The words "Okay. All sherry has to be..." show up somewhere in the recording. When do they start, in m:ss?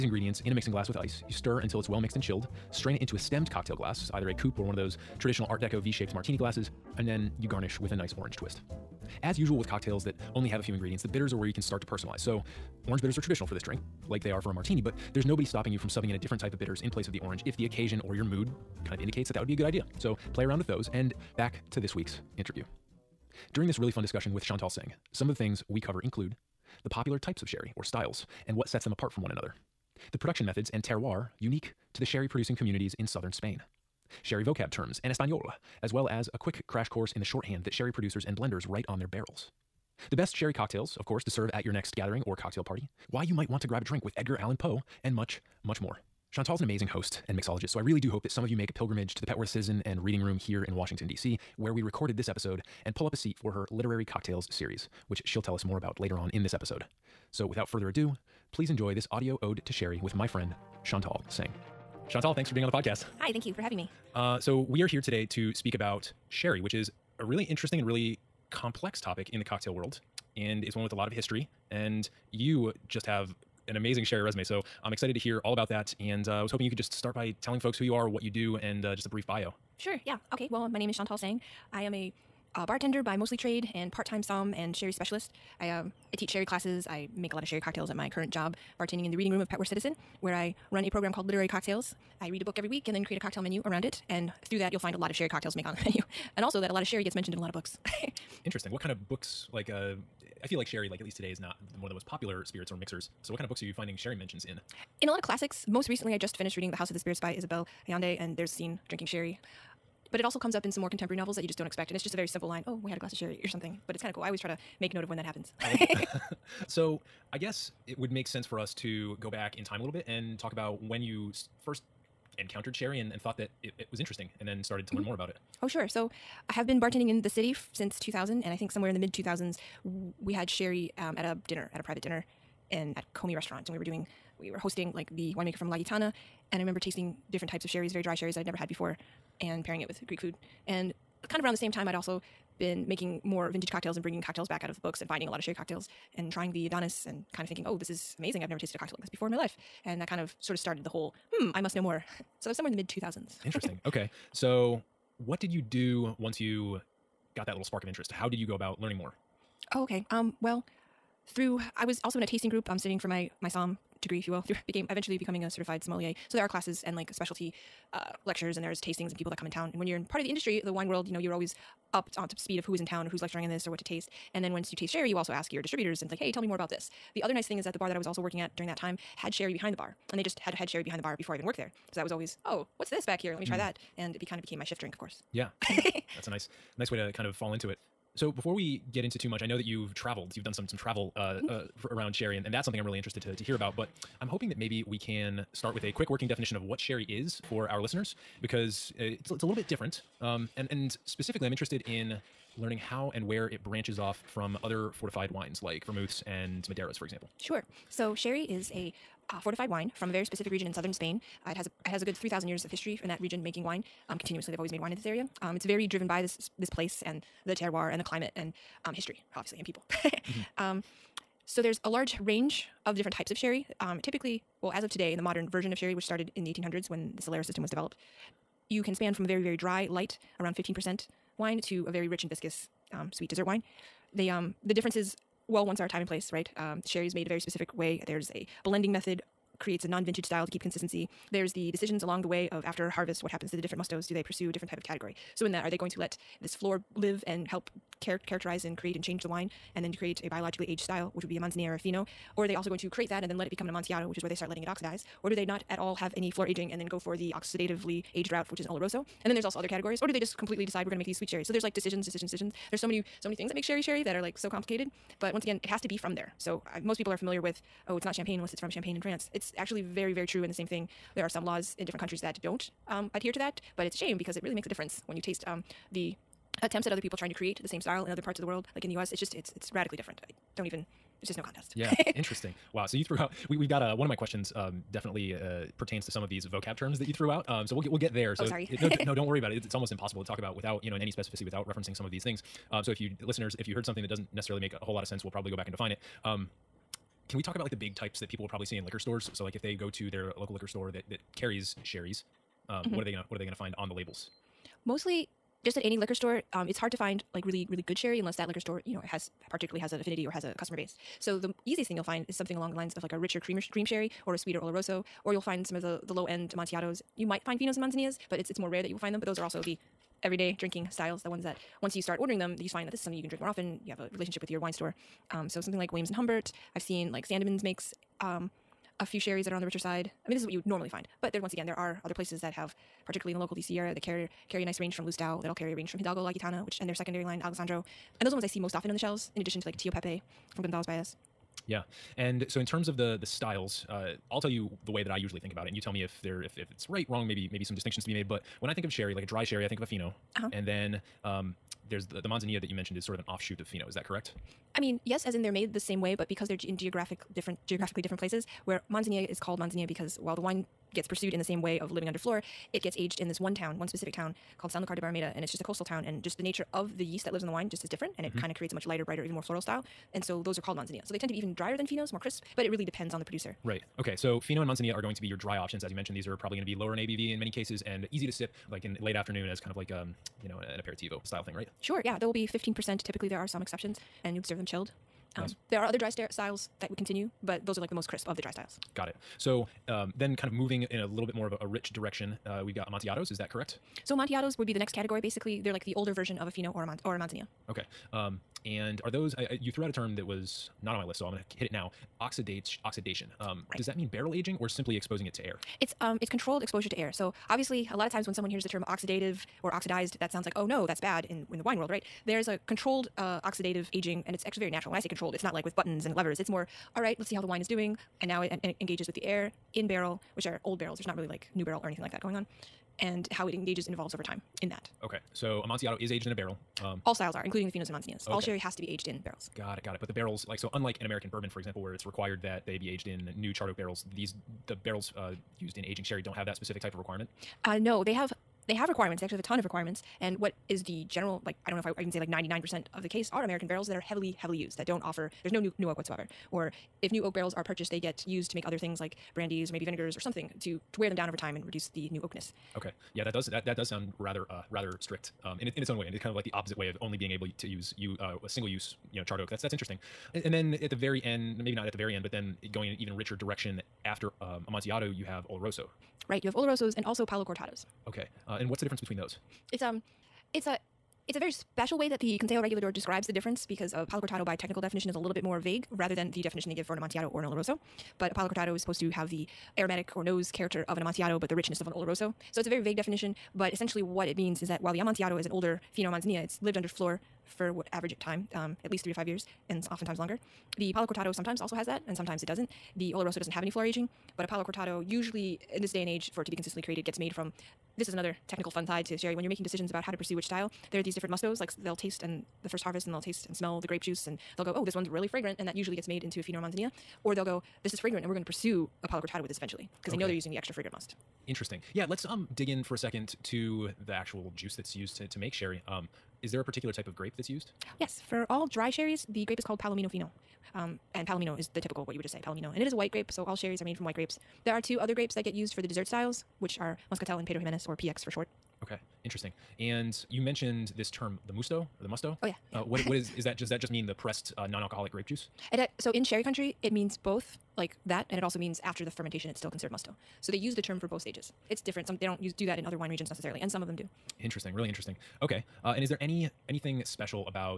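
7:08.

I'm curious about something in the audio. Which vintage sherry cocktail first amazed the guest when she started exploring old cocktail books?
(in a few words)
Adonis.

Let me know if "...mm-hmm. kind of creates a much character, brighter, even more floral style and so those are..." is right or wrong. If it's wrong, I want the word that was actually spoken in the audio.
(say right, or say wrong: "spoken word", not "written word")
wrong: "lighter", not "character".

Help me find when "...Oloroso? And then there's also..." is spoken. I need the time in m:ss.
4:18.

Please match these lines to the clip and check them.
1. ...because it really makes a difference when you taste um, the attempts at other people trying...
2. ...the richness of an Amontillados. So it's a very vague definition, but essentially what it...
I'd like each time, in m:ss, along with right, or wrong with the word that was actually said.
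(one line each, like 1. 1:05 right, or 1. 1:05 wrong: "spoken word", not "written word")
1. 4:34 right
2. 8:01 wrong: "Oloroso", not "Amontillados".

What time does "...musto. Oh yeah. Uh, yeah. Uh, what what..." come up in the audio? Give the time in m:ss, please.
8:52.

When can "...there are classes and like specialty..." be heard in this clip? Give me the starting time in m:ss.
2:46.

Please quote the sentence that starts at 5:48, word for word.
But when I think of sherry, like a dry sherry, I think of a fino, uh-huh.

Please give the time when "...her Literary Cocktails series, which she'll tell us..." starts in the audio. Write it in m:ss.
0:53.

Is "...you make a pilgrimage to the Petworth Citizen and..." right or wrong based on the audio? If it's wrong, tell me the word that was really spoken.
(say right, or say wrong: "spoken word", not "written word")
right.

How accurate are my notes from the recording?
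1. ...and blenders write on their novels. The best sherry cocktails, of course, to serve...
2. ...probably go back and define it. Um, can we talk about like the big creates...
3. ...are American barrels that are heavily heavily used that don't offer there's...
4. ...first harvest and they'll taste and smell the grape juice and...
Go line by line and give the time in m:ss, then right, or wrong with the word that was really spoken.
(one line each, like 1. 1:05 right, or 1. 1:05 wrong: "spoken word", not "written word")
1. 0:38 wrong: "barrels", not "novels"
2. 4:55 wrong: "types", not "creates"
3. 7:23 right
4. 8:22 right.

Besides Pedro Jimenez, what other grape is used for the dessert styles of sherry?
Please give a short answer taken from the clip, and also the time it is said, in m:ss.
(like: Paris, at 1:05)
Muscatel, at 8:47.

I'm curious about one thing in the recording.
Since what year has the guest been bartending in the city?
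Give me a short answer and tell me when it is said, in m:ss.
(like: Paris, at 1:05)
2000, at 2:07.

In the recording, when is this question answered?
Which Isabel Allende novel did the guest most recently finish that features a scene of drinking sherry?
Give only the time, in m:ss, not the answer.
1:46.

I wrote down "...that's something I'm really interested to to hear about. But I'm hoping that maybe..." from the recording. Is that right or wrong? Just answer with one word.
right.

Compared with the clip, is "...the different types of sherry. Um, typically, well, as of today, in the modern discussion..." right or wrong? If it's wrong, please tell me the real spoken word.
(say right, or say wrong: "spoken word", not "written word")
wrong: "version", not "discussion".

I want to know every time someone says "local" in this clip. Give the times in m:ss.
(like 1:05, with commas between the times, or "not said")
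5:00, 5:33.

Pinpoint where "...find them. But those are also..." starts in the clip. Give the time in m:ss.
5:19.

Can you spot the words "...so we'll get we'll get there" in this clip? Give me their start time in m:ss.
4:47.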